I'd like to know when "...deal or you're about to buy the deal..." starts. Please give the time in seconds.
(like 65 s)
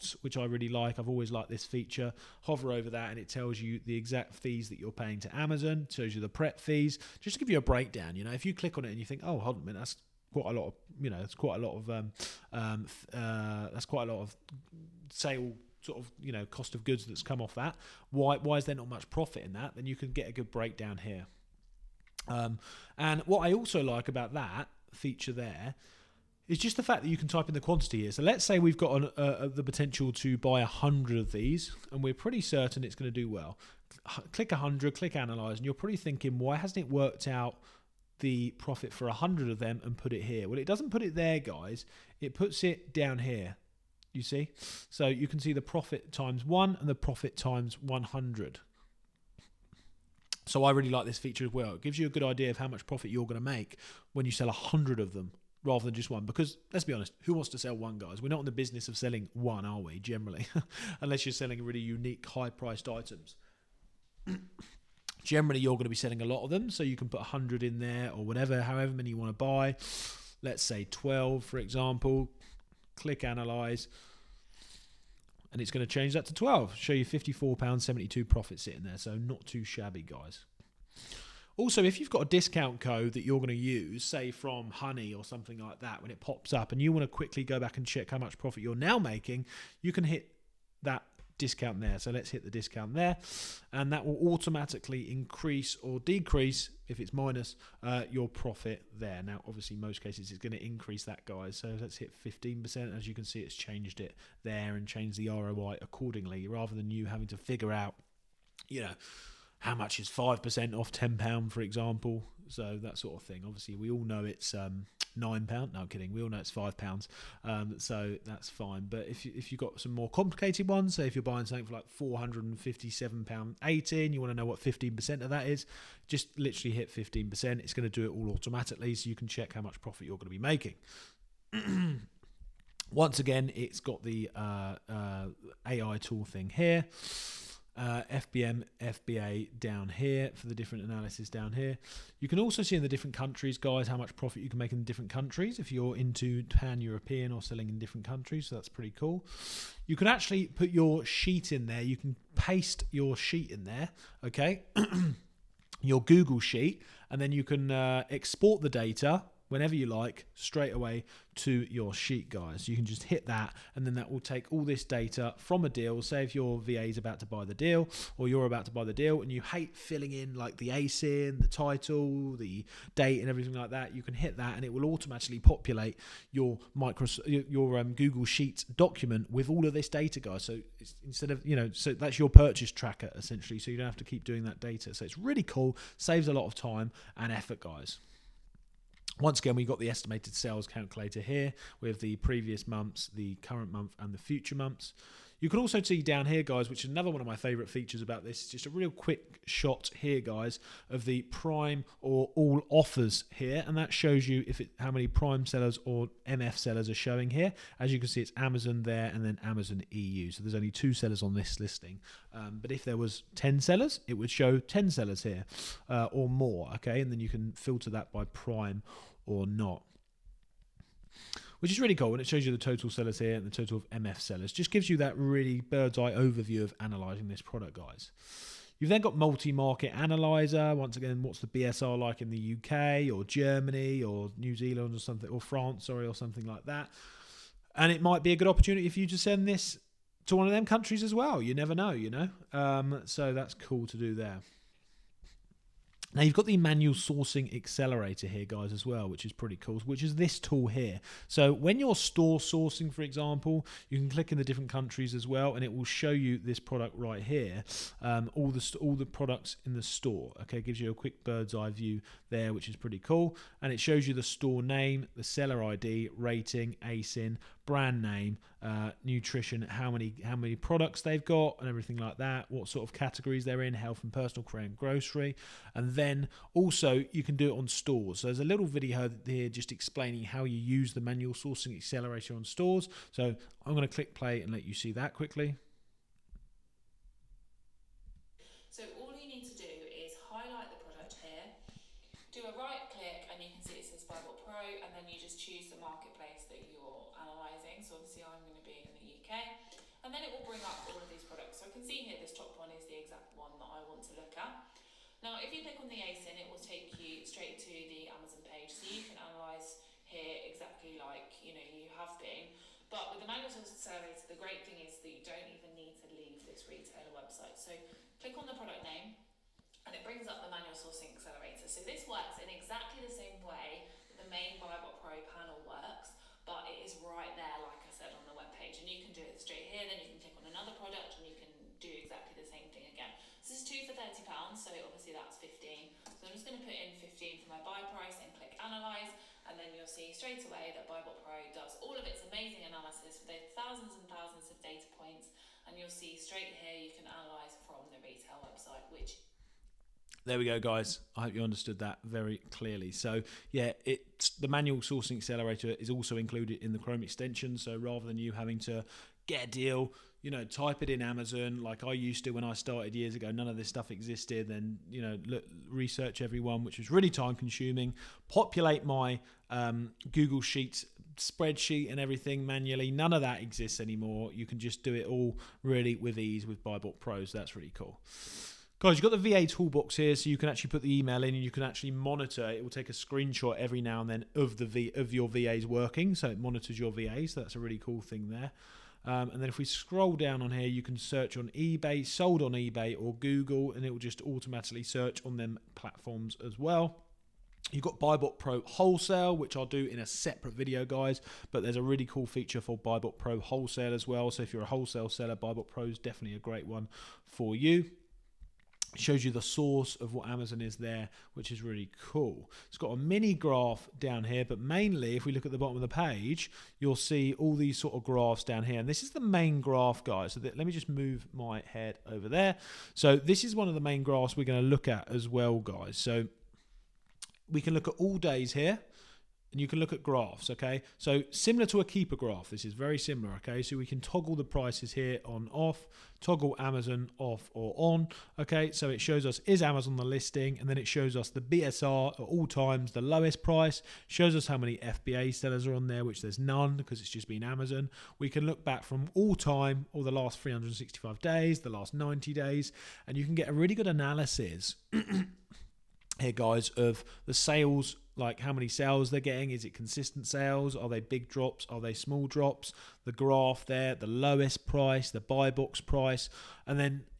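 167 s.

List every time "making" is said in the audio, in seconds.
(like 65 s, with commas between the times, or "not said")
88 s, 130 s.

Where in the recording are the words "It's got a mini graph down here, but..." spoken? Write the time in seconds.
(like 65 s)
412 s.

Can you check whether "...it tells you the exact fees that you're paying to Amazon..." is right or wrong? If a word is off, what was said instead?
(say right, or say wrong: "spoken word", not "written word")
right.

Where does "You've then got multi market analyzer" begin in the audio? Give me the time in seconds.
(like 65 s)
228 s.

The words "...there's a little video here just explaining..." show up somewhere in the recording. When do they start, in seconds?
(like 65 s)
278 s.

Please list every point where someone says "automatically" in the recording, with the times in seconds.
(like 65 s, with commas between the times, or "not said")
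94 s, 128 s, 174 s, 394 s.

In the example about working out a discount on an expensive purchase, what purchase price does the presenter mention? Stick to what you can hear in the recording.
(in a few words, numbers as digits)
£457.18.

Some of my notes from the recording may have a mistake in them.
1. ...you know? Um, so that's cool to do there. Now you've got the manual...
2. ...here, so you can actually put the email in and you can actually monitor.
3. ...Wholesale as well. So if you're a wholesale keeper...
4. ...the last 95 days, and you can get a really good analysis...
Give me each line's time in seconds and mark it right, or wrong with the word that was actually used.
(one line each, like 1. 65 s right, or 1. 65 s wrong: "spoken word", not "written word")
1. 241 s right
2. 379 s right
3. 403 s wrong: "seller", not "keeper"
4. 451 s wrong: "90", not "95".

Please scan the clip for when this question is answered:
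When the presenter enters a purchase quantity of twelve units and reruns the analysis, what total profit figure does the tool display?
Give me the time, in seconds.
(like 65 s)
77 s.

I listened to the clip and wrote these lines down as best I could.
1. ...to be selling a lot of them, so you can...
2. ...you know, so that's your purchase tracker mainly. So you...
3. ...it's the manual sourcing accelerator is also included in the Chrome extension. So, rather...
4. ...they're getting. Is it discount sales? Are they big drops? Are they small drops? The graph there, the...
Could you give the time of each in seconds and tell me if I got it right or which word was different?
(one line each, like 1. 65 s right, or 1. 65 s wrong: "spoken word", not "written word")
1. 65 s right
2. 181 s wrong: "essentially", not "mainly"
3. 353 s right
4. 459 s wrong: "consistent", not "discount".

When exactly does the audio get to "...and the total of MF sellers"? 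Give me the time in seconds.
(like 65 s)
223 s.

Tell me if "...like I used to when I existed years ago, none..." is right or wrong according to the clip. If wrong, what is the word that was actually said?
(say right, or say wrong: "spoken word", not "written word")
wrong: "started", not "existed".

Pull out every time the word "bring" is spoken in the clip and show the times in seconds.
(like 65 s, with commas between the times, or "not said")
300 s, 320 s.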